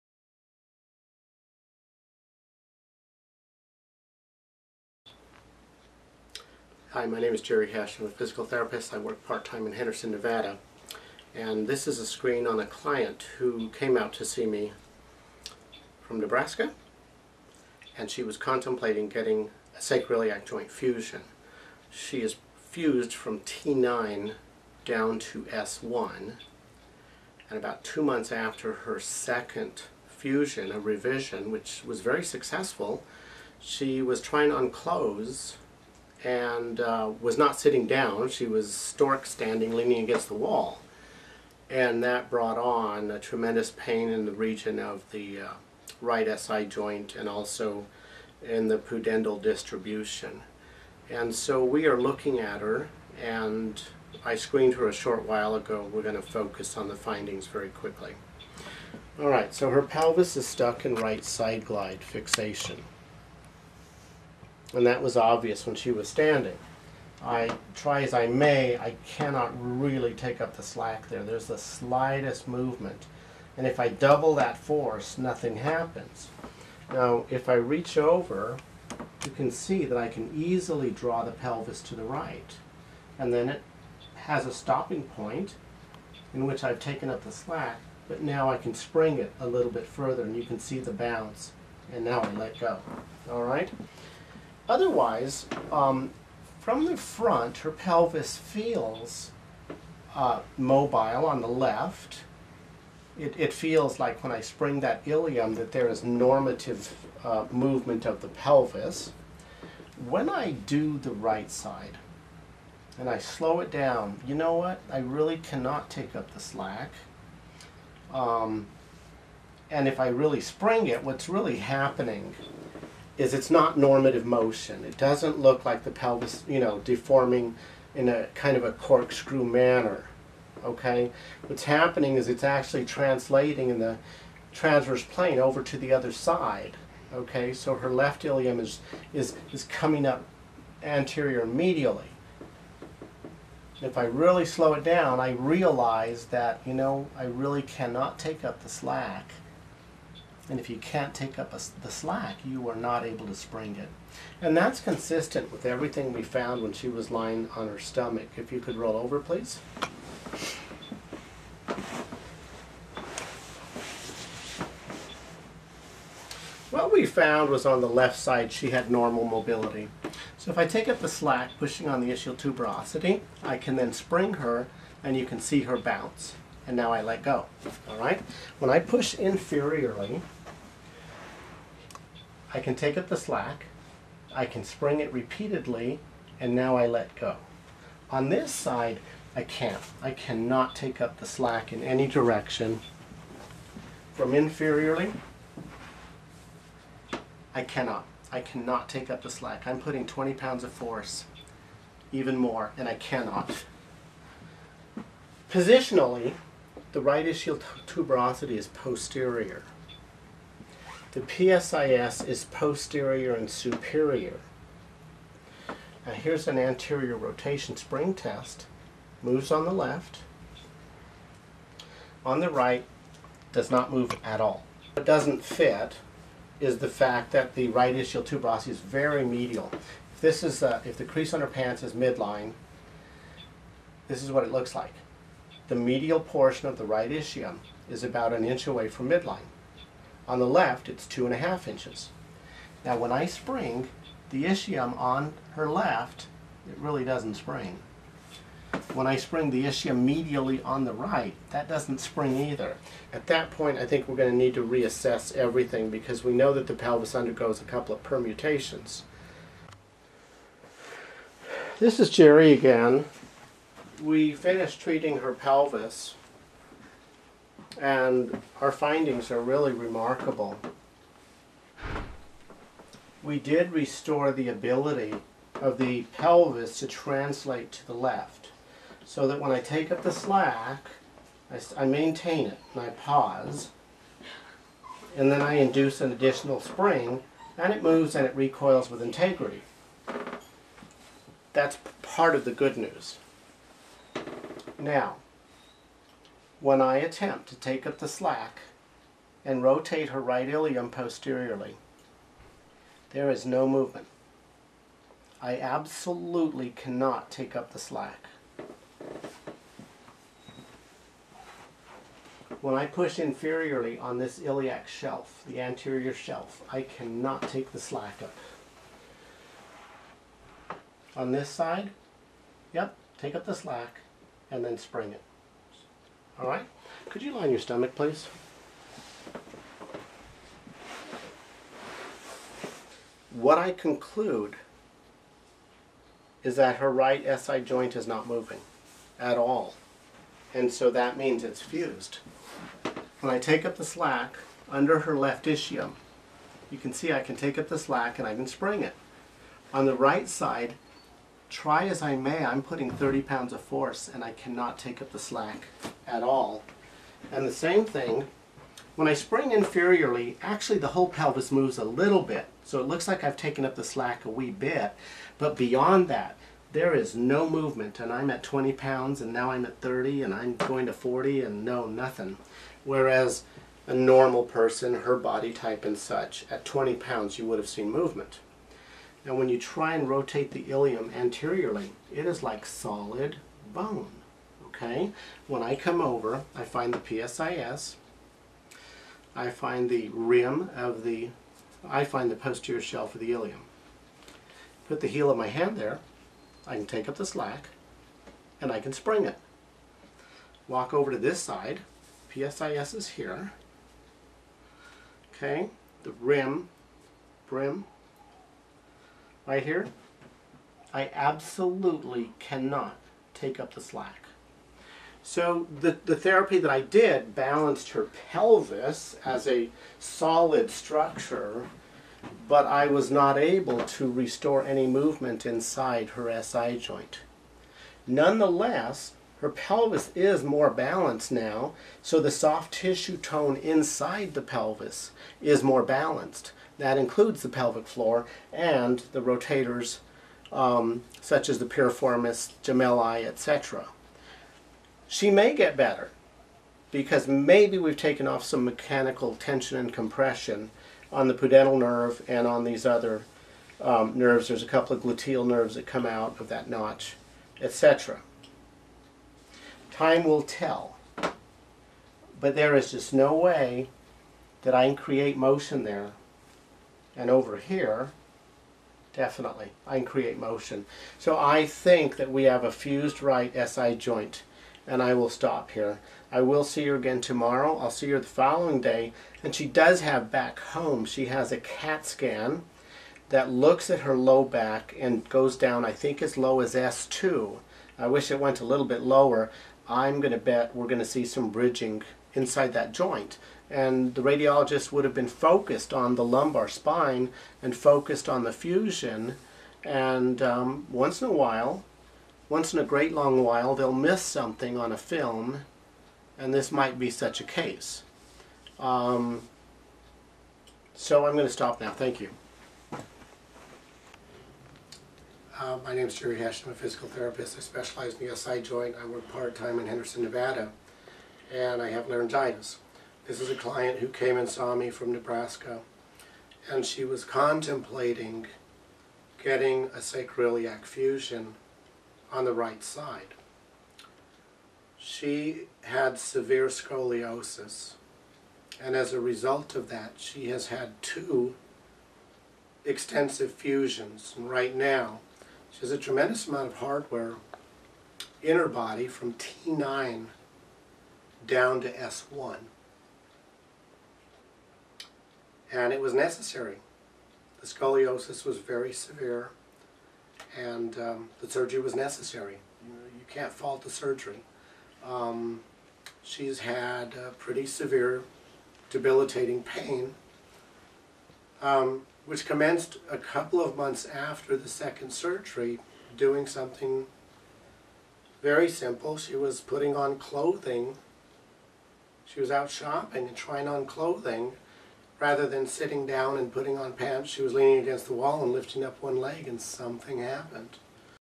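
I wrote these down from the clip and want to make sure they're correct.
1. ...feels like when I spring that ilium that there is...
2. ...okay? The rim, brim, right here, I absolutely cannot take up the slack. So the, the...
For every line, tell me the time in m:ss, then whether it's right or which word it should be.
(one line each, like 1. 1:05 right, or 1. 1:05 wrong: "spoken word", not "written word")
1. 1:43 right
2. 6:45 right.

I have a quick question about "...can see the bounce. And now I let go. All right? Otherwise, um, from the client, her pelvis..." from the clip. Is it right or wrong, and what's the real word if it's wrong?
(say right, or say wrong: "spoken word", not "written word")
wrong: "front", not "client".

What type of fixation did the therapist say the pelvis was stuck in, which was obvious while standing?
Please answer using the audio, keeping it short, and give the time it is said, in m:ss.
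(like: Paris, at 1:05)
right side glide fixation, at 1:00.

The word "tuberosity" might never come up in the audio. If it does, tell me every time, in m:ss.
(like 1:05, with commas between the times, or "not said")
2:52, 3:27, 3:48.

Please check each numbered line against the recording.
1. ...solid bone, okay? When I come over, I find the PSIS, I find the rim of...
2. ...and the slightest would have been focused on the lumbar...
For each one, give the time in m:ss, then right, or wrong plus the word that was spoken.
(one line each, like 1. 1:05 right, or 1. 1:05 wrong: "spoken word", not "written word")
1. 6:22 right
2. 8:13 wrong: "radiologist", not "slightest".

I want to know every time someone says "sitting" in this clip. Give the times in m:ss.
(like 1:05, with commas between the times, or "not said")
0:37, 9:45.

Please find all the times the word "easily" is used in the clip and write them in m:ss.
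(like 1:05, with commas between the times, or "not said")
1:20.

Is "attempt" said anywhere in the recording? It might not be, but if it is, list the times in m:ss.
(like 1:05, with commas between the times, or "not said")
4:56.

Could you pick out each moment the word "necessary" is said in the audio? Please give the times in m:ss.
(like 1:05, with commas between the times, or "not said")
9:16, 9:21.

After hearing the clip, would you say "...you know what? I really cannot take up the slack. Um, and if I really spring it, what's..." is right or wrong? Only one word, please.
right.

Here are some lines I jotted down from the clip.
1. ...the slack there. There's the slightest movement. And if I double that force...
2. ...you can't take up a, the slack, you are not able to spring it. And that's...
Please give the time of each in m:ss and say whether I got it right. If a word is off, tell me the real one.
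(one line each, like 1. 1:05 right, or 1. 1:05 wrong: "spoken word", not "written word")
1. 1:10 right
2. 2:30 right.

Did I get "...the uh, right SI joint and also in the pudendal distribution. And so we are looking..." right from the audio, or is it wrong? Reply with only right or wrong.
right.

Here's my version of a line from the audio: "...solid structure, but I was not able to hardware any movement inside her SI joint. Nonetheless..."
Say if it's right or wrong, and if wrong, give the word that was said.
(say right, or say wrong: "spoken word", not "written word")
wrong: "restore", not "hardware".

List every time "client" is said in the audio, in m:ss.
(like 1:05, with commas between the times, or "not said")
0:12, 8:43.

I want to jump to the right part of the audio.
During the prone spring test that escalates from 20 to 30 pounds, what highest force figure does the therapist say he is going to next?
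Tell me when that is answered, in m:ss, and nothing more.
6:10.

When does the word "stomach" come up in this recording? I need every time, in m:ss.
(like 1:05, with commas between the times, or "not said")
2:37, 5:27.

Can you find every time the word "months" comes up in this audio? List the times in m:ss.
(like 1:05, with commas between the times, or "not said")
0:28, 9:33.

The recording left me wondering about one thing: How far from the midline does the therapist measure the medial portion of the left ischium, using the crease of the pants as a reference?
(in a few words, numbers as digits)
2.5 inches.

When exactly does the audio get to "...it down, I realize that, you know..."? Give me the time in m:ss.
2:24.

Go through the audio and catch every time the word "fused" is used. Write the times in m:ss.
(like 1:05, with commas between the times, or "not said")
0:22, 5:41, 7:52.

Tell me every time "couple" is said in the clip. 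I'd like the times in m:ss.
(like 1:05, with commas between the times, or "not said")
4:17, 7:34, 9:33.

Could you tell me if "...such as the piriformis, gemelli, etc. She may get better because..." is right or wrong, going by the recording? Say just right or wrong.
right.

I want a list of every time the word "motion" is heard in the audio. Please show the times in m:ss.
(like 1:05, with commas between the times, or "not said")
2:04, 7:45, 7:50.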